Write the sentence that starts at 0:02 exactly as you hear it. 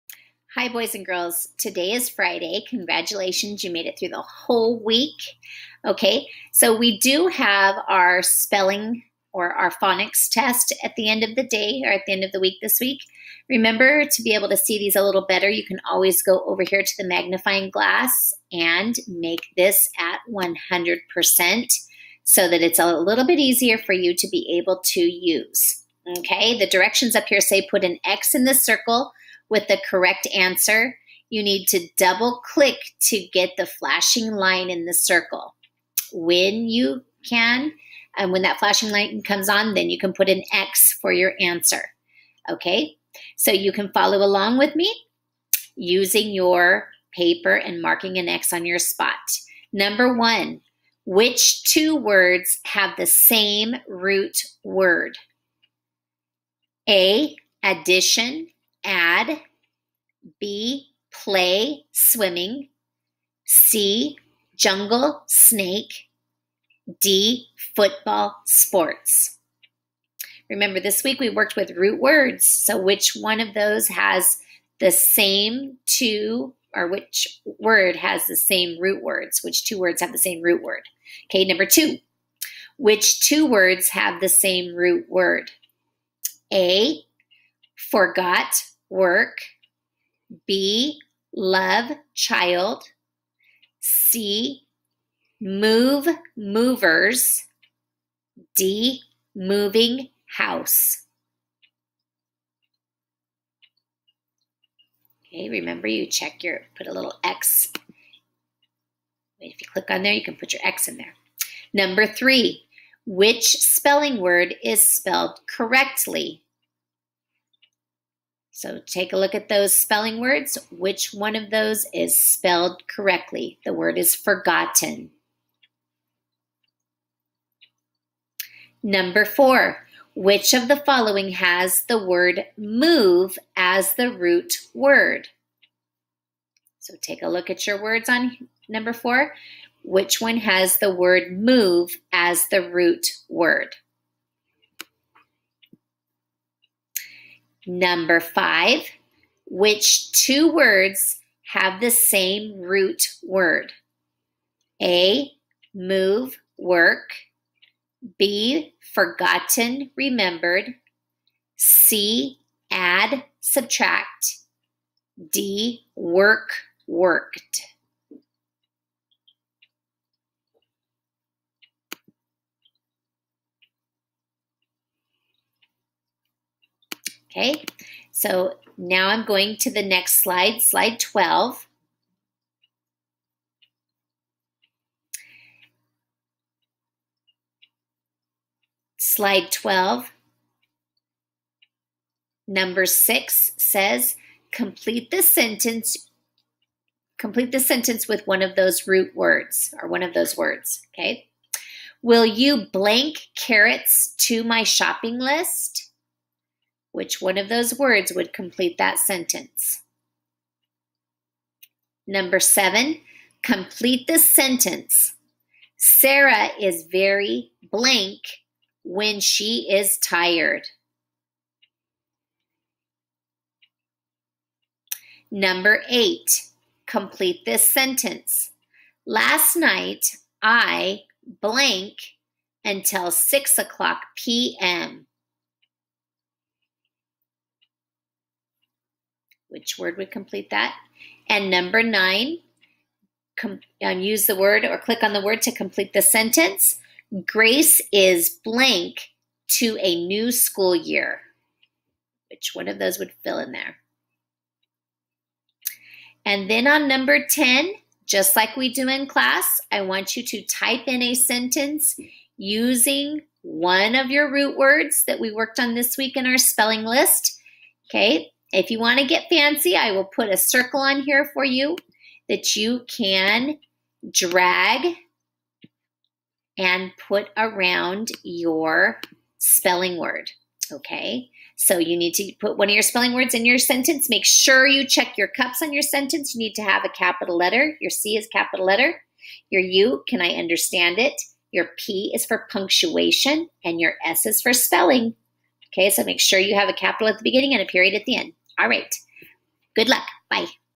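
Congratulations, you made it through the whole week.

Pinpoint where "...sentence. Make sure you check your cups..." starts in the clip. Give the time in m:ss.
4:43.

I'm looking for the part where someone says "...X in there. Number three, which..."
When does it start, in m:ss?
1:50.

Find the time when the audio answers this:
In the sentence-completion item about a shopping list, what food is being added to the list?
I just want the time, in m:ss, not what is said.
3:23.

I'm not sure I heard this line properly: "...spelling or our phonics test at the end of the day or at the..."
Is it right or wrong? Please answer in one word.
right.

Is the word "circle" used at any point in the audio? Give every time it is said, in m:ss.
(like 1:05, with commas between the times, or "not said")
0:28, 0:34, 4:30.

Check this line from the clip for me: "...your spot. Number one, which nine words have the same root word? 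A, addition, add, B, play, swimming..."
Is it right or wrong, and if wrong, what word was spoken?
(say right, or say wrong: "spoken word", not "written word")
wrong: "two", not "nine".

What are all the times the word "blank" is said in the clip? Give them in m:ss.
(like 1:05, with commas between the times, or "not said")
3:22, 3:37, 3:51, 4:08.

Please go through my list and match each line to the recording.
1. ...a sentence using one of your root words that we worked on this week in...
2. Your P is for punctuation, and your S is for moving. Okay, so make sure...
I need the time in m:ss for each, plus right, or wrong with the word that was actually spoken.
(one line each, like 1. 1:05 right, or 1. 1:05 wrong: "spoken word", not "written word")
1. 4:21 right
2. 4:51 wrong: "spelling", not "moving".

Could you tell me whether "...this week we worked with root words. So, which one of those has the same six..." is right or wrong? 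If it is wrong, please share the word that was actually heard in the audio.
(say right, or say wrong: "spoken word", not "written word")
wrong: "two", not "six".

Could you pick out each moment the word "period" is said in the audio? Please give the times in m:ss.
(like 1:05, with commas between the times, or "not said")
4:57.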